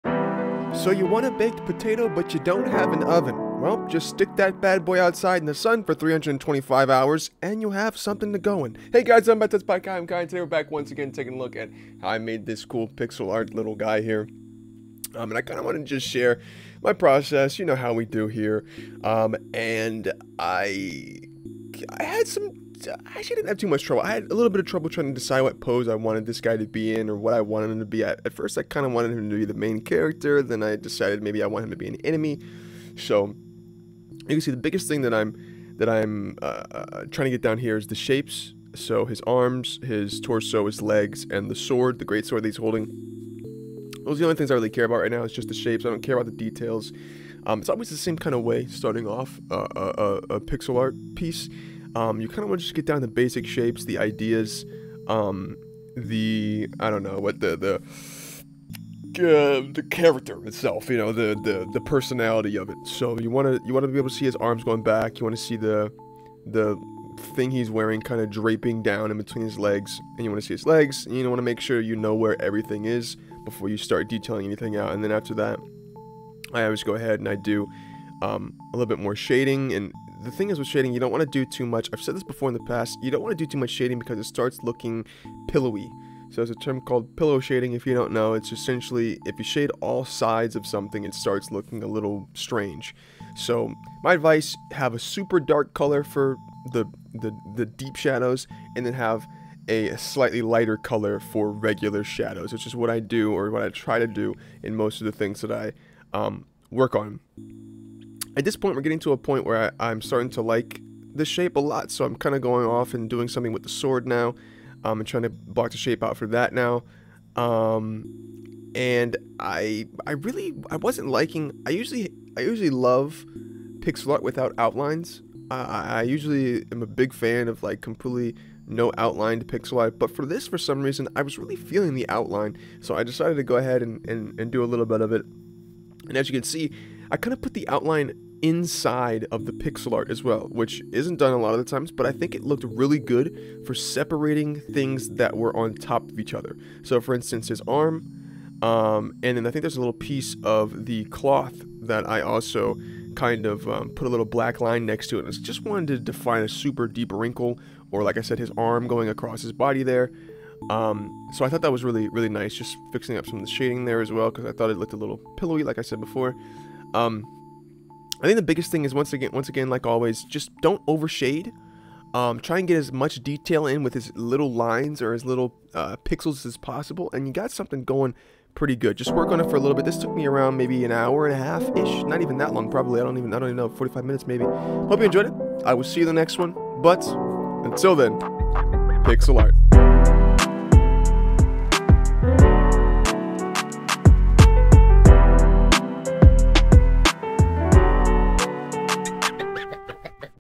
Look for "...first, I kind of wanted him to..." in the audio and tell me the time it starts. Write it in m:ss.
0:28.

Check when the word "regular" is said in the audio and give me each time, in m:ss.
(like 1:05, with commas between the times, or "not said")
1:41.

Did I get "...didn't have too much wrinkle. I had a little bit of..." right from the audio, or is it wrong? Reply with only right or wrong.
wrong.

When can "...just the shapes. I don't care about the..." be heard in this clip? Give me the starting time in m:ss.
0:45.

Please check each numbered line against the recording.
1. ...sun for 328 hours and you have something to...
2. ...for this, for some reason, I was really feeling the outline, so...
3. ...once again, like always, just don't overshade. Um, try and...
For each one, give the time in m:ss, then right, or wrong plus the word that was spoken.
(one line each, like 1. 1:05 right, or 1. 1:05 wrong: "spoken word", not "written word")
1. 0:05 wrong: "325", not "328"
2. 2:10 right
3. 2:49 right.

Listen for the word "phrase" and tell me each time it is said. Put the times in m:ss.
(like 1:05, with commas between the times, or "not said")
not said.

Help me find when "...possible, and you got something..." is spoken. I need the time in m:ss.
2:56.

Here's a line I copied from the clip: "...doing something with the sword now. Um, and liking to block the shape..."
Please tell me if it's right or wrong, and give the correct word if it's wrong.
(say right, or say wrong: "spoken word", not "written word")
wrong: "trying", not "liking".